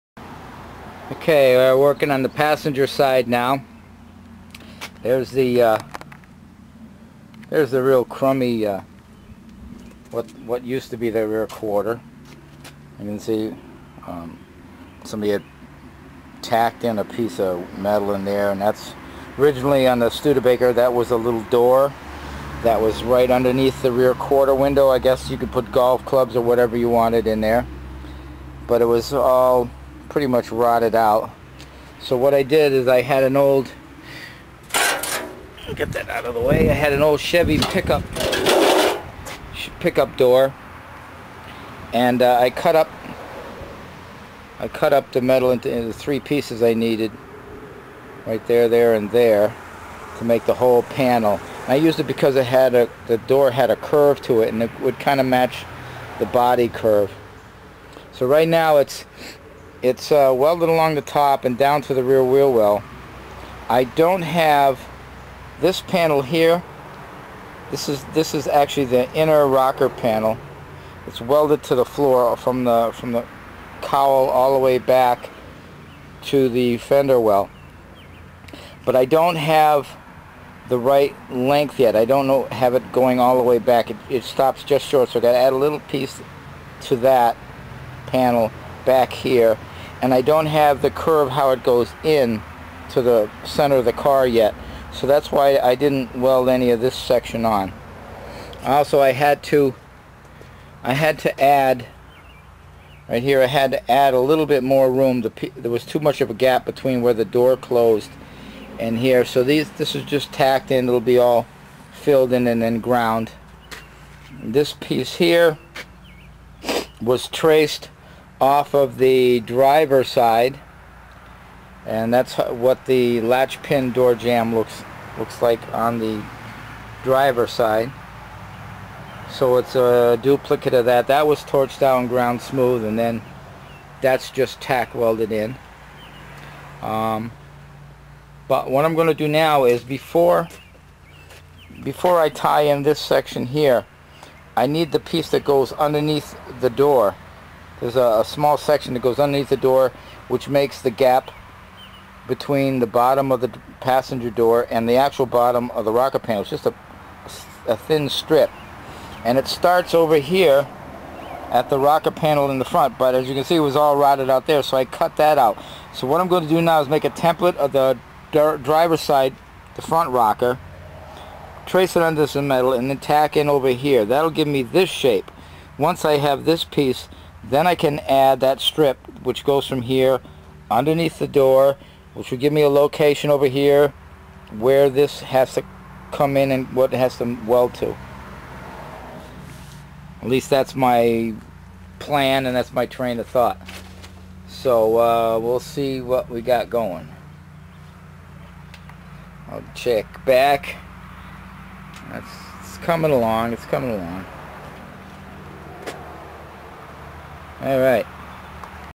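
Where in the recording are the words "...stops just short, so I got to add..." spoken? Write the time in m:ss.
1:24.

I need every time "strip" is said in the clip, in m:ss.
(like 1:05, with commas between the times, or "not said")
2:38, 2:58.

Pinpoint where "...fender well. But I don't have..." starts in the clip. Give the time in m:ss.
1:16.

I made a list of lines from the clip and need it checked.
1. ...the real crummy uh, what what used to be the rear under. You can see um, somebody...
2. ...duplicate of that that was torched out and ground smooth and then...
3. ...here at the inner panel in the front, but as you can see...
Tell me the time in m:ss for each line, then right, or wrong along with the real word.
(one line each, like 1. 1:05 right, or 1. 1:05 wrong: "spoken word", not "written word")
1. 0:07 wrong: "quarter", not "under"
2. 2:10 right
3. 2:40 wrong: "rocker", not "inner".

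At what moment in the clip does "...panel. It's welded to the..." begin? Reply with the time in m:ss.
1:09.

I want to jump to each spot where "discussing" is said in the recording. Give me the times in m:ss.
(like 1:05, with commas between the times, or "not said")
not said.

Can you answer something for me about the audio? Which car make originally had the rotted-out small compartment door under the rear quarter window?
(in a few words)
Studebaker.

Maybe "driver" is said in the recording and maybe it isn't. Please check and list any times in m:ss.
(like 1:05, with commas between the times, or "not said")
1:59, 2:07, 2:48.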